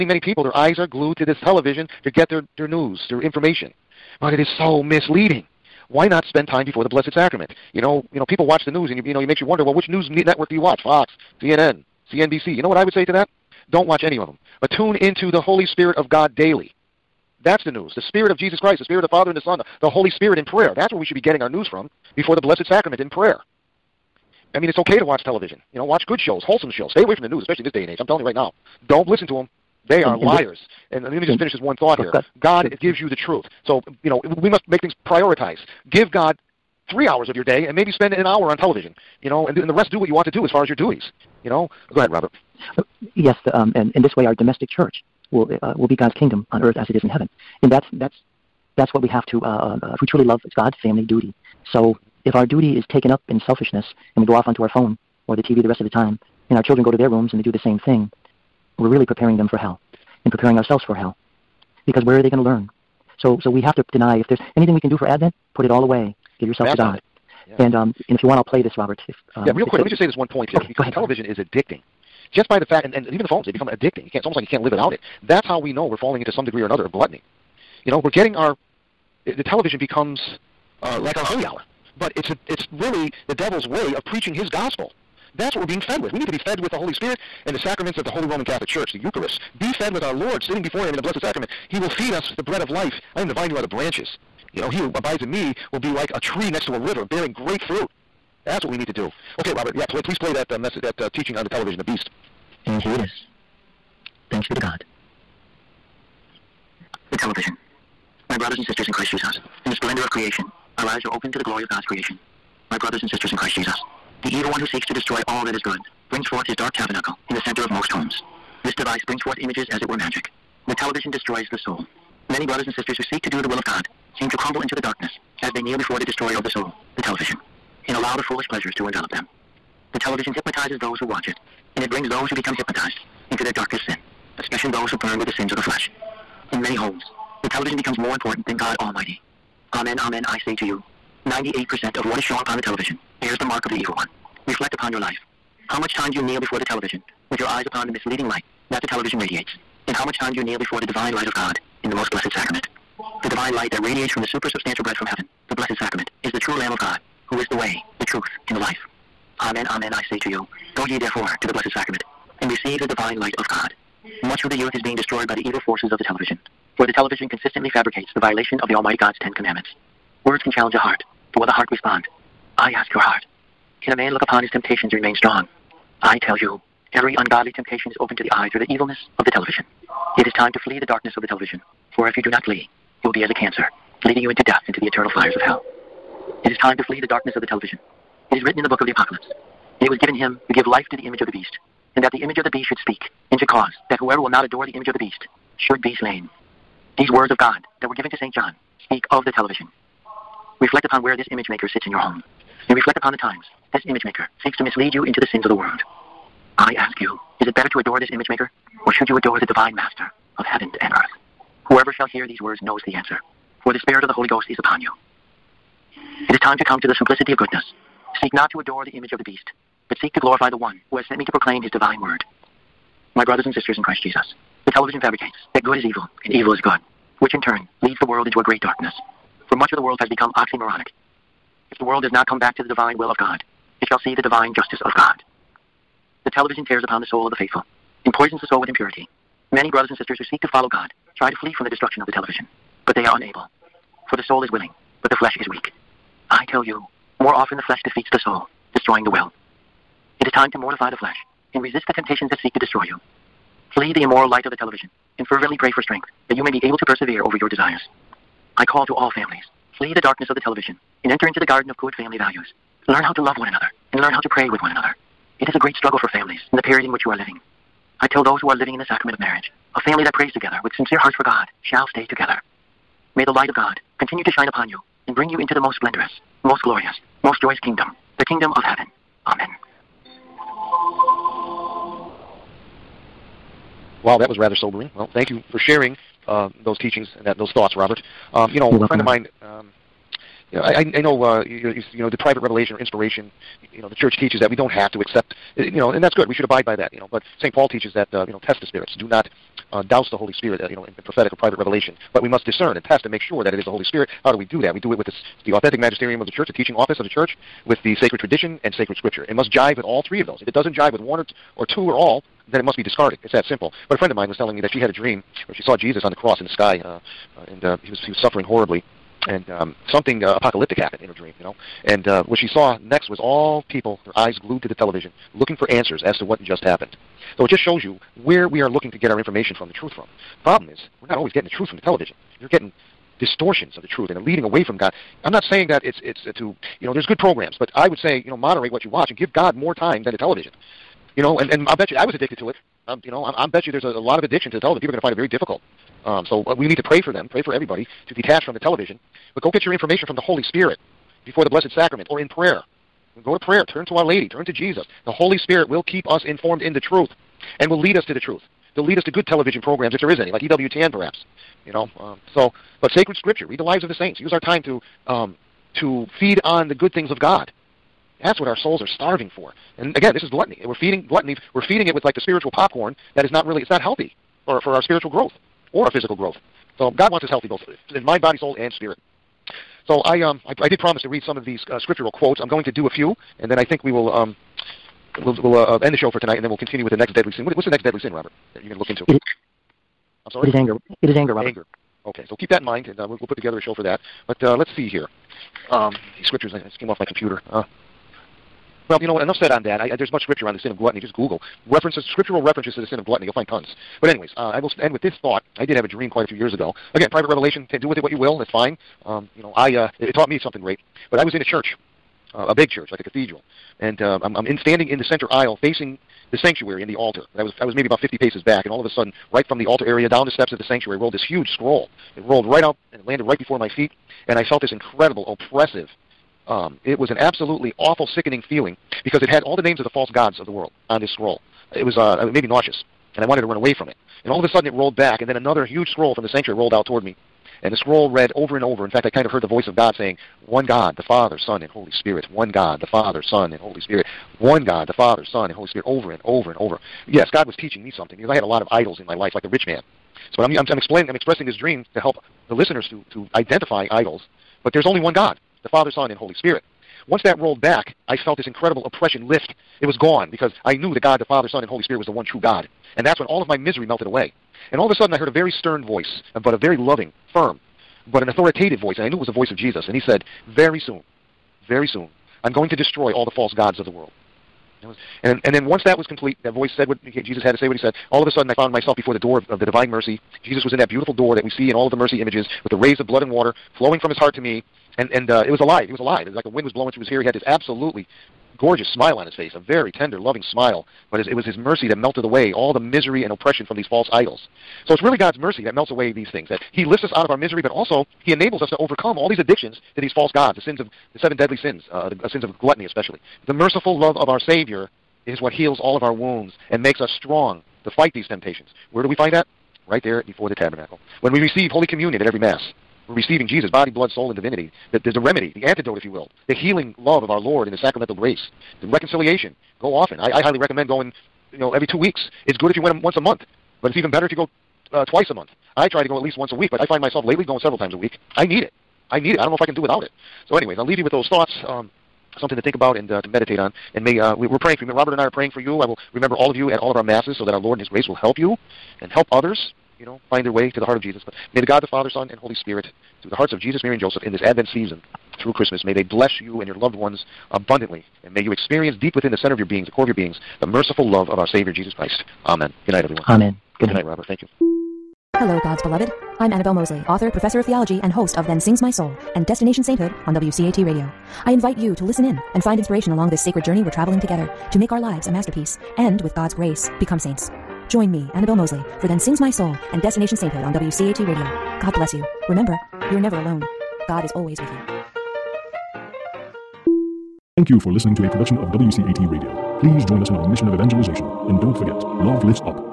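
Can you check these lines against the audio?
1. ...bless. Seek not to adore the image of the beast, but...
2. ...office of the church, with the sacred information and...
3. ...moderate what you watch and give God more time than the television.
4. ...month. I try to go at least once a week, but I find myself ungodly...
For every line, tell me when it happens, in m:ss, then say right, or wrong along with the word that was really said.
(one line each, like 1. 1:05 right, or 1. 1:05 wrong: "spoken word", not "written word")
1. 3:37 wrong: "goodness", not "bless"
2. 5:06 wrong: "tradition", not "information"
3. 5:38 right
4. 8:45 wrong: "lately", not "ungodly".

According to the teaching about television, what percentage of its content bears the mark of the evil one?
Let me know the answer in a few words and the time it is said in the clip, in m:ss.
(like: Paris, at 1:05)
98%, at 2:21.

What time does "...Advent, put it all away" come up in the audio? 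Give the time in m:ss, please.
1:05.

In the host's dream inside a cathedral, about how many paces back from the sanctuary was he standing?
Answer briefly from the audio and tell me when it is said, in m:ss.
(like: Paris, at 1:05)
50, at 6:58.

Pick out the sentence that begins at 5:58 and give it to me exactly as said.
They'll lead us to good television programs if there is any, like EWTN perhaps.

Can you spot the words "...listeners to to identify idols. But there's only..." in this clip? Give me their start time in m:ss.
7:32.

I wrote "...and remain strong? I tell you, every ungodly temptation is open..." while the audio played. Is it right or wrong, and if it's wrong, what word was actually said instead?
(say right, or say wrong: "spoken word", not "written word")
right.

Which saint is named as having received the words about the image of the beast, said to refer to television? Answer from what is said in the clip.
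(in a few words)
St. John.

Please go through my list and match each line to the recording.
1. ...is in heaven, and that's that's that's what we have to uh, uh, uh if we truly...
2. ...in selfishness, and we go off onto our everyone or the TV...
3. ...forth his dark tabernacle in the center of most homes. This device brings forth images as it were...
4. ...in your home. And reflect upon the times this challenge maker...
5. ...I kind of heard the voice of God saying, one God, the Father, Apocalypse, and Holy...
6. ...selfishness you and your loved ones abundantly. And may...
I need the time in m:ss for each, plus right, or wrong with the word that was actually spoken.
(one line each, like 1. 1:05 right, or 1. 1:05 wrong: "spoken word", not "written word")
1. 0:46 right
2. 0:53 wrong: "phone", not "everyone"
3. 1:56 right
4. 3:21 wrong: "image", not "challenge"
5. 7:19 wrong: "Son", not "Apocalypse"
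6. 9:06 wrong: "bless", not "selfishness".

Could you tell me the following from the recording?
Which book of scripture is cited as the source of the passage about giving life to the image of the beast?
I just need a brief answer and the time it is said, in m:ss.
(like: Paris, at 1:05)
Apocalypse, at 3:08.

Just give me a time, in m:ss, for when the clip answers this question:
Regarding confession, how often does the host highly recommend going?
8:41.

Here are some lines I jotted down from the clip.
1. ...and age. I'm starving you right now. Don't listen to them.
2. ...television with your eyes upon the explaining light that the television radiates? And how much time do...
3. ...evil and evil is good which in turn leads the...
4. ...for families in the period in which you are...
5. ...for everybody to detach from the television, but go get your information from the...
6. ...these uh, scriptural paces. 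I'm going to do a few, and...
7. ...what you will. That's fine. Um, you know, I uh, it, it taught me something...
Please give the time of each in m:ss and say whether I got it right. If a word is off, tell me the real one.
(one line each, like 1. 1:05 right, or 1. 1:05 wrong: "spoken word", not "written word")
1. 0:27 wrong: "telling", not "starving"
2. 2:26 wrong: "misleading", not "explaining"
3. 3:45 right
4. 4:26 right
5. 5:47 right
6. 6:21 wrong: "quotes", not "paces"
7. 6:48 right.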